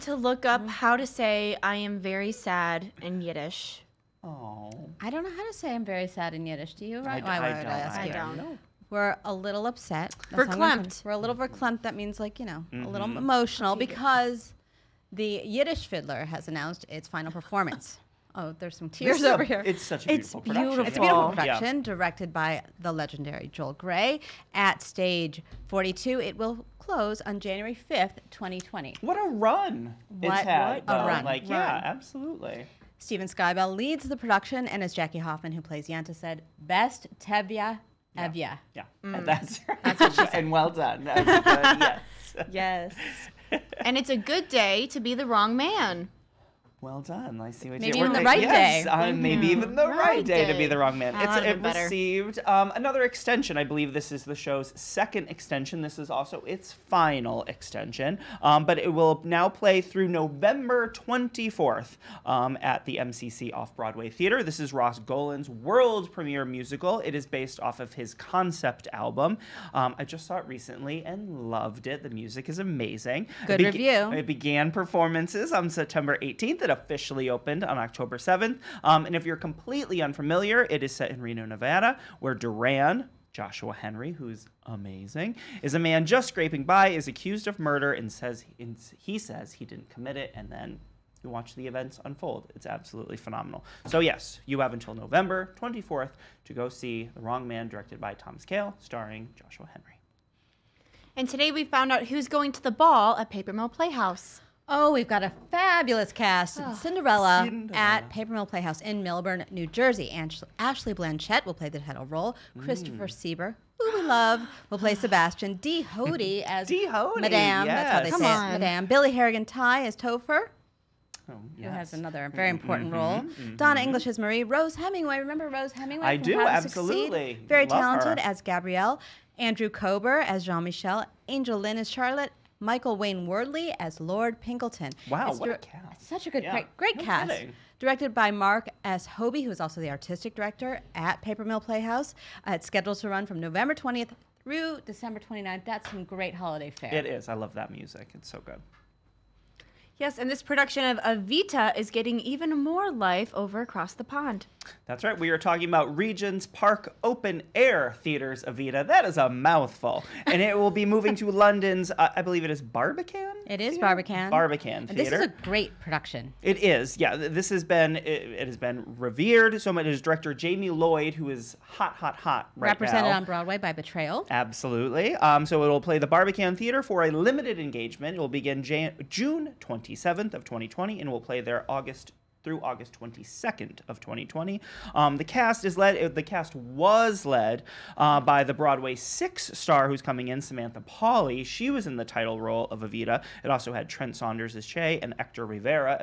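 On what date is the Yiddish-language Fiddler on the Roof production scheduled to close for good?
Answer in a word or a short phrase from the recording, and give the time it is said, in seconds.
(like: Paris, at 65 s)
January 5th, 2020, at 27 s.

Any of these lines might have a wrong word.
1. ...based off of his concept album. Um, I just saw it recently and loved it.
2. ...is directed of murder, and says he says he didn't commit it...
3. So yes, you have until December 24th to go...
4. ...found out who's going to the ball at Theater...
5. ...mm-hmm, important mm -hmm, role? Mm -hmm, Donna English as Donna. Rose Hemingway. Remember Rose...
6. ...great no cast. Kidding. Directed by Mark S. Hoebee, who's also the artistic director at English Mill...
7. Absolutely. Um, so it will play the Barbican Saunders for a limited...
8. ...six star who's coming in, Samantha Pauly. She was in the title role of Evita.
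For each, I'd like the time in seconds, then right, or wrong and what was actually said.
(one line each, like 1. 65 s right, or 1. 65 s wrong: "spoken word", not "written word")
1. 67 s right
2. 86 s wrong: "accused", not "directed"
3. 93 s wrong: "November", not "December"
4. 101 s wrong: "Paper", not "Theater"
5. 122 s wrong: "Marie", not "Donna"
6. 136 s wrong: "Paper", not "English"
7. 174 s wrong: "Theater", not "Saunders"
8. 188 s right.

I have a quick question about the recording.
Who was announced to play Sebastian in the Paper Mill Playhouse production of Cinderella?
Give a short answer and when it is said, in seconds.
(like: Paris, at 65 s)
Christopher Sieber, at 112 s.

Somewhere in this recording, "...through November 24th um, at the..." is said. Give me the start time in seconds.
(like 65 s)
59 s.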